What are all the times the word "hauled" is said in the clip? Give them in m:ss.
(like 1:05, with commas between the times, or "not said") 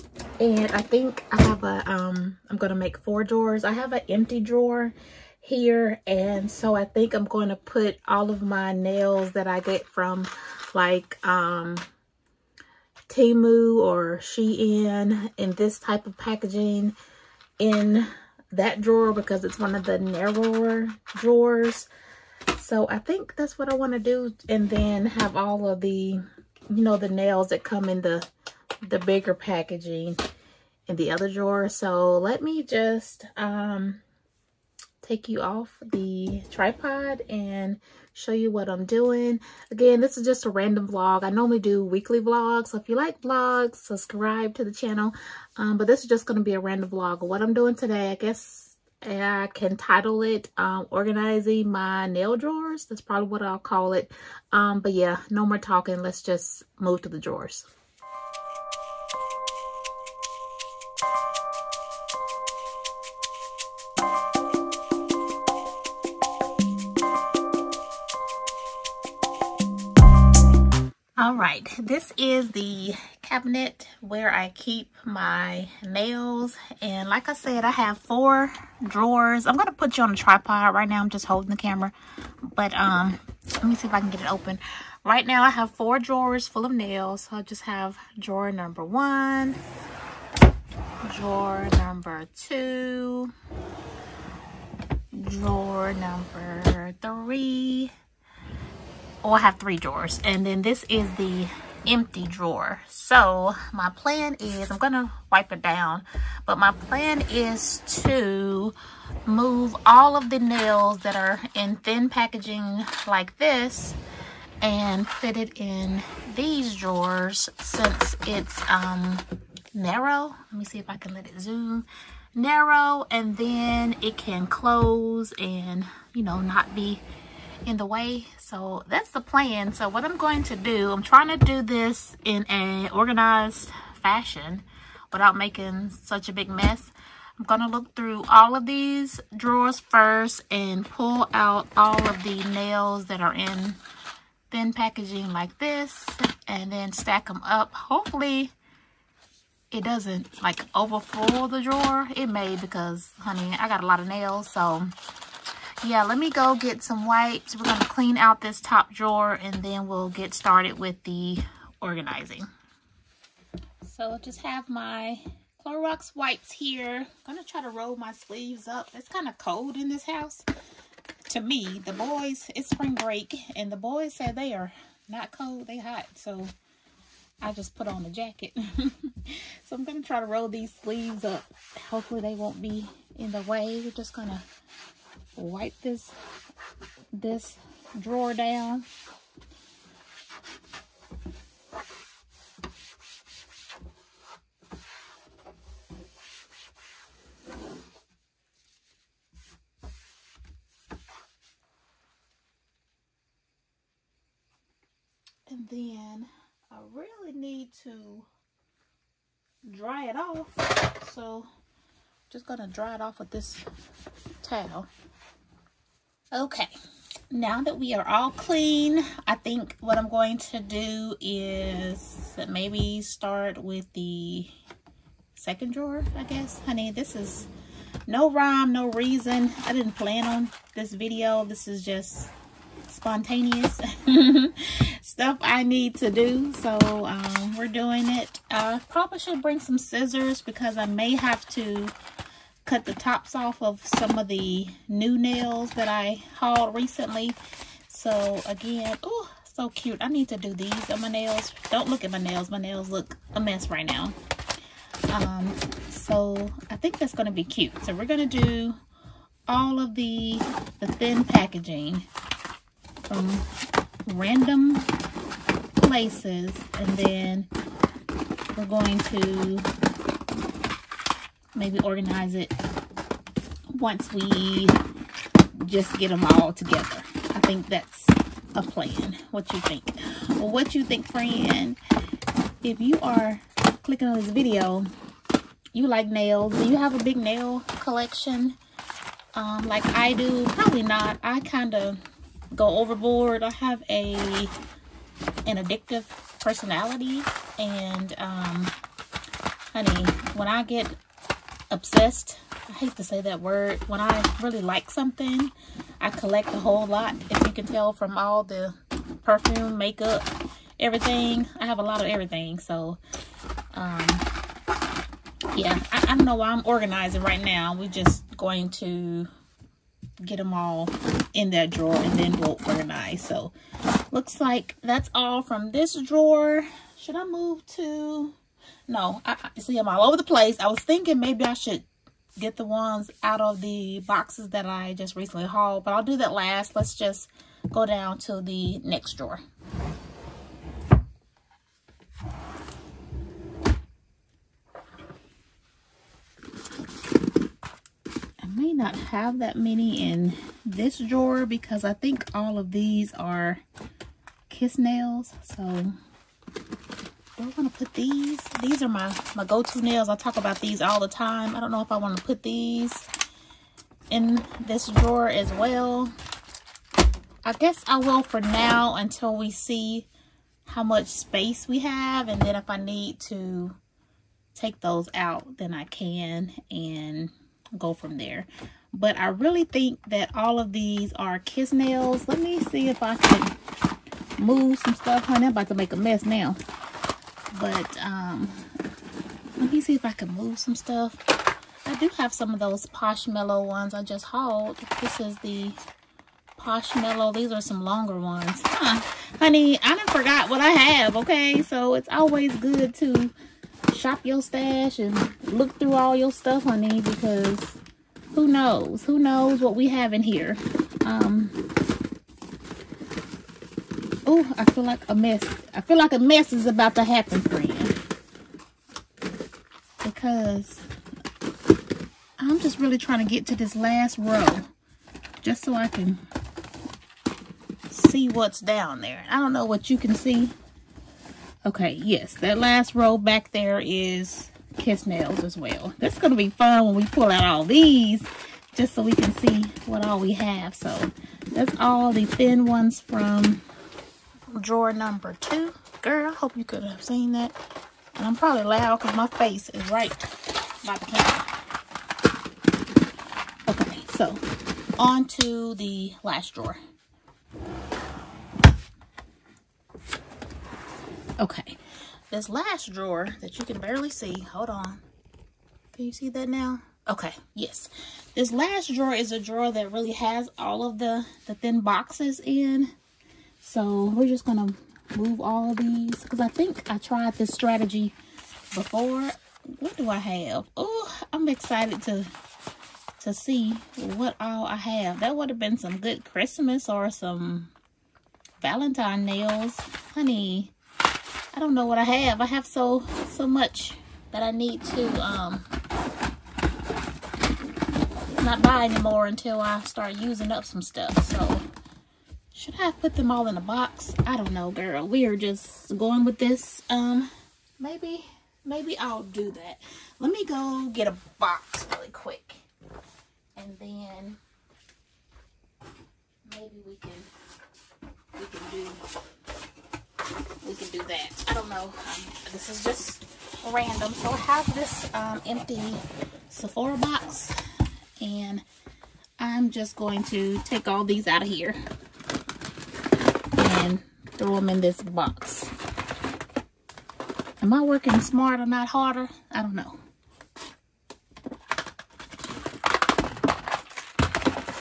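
4:06, 5:35, 6:34.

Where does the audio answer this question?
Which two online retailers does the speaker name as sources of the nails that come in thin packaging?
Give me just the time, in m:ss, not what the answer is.
0:13.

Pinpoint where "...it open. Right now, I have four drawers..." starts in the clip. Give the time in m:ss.
1:24.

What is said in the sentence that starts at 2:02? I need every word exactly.
Narrow and then it can close and, you know, not be in the way.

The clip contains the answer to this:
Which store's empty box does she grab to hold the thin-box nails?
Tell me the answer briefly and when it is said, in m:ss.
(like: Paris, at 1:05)
Sephora, at 8:46.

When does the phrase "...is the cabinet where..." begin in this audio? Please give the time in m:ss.
1:12.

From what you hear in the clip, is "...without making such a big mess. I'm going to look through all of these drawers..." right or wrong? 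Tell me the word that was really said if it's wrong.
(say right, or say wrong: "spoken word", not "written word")
right.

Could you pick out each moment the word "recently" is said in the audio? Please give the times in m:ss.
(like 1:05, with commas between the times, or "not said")
4:06, 5:35.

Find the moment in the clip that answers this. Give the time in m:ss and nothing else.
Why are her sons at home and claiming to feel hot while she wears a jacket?
2:52.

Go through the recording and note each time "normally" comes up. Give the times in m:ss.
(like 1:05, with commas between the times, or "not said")
0:41.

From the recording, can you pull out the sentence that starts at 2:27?
Hopefully it doesn't like overfull the drawer.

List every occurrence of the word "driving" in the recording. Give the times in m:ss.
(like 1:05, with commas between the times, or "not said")
not said.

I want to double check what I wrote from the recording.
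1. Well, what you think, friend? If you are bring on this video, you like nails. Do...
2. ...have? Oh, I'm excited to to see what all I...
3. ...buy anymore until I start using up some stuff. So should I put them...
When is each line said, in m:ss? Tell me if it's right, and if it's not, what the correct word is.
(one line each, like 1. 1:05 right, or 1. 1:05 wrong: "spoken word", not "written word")
1. 4:40 wrong: "clicking", not "bring"
2. 8:00 right
3. 8:18 right.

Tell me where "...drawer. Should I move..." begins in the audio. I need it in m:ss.
5:26.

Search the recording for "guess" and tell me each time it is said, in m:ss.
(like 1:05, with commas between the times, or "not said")
0:48, 3:46, 6:07.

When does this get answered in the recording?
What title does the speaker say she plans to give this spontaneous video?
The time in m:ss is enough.
0:50.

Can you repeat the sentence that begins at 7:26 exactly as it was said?
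Girl, I hope you could have seen that.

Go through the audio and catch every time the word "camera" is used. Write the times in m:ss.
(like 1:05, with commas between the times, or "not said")
1:21, 7:31.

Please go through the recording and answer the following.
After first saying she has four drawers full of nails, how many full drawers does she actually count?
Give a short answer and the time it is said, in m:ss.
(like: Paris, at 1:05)
3, at 1:39.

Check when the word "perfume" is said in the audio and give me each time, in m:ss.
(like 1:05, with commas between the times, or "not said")
5:09.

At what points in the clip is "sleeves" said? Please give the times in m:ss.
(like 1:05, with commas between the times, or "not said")
2:48, 3:00.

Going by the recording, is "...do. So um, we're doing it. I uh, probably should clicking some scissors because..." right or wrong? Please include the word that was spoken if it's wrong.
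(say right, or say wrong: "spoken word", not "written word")
wrong: "bring", not "clicking".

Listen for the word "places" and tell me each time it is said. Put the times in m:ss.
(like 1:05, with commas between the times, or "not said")
4:25, 5:30.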